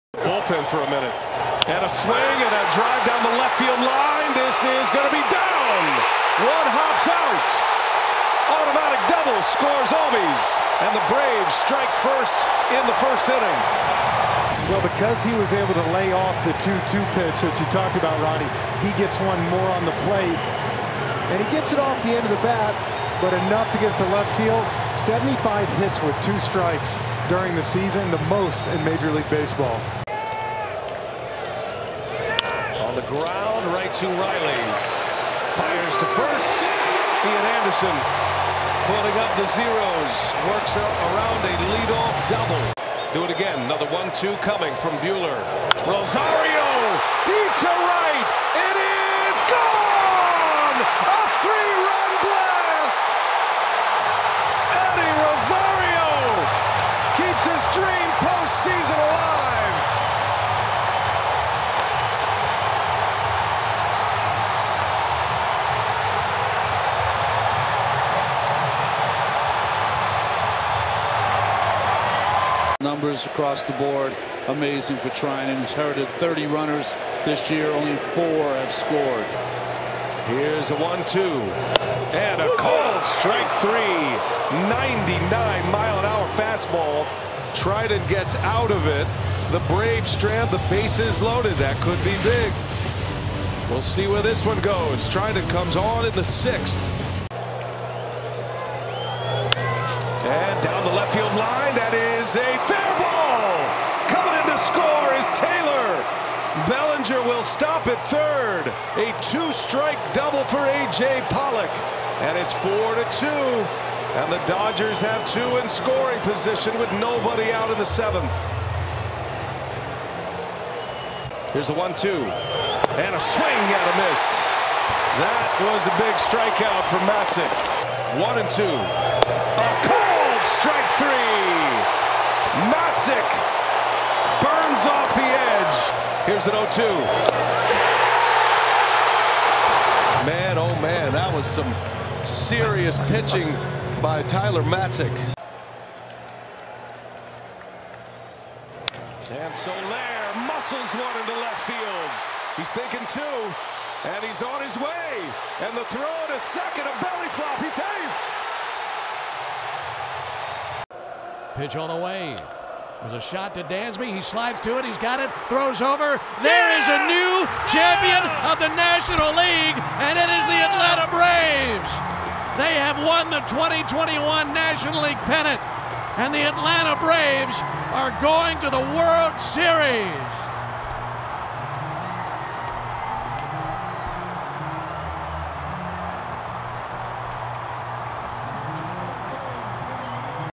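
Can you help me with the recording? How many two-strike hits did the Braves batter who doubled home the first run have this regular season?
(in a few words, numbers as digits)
75.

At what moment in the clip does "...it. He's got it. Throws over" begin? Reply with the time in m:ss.
2:44.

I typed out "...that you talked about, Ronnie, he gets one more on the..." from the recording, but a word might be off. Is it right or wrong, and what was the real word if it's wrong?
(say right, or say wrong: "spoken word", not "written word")
right.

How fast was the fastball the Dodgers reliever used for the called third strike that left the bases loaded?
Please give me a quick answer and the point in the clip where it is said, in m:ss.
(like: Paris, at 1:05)
99 mph, at 1:24.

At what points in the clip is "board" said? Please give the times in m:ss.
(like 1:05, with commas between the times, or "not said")
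1:13.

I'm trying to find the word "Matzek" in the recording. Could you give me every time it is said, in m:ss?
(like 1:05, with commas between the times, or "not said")
2:07, 2:12, 2:24.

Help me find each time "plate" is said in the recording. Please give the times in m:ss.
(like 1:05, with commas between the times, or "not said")
0:20.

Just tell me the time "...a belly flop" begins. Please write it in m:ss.
2:36.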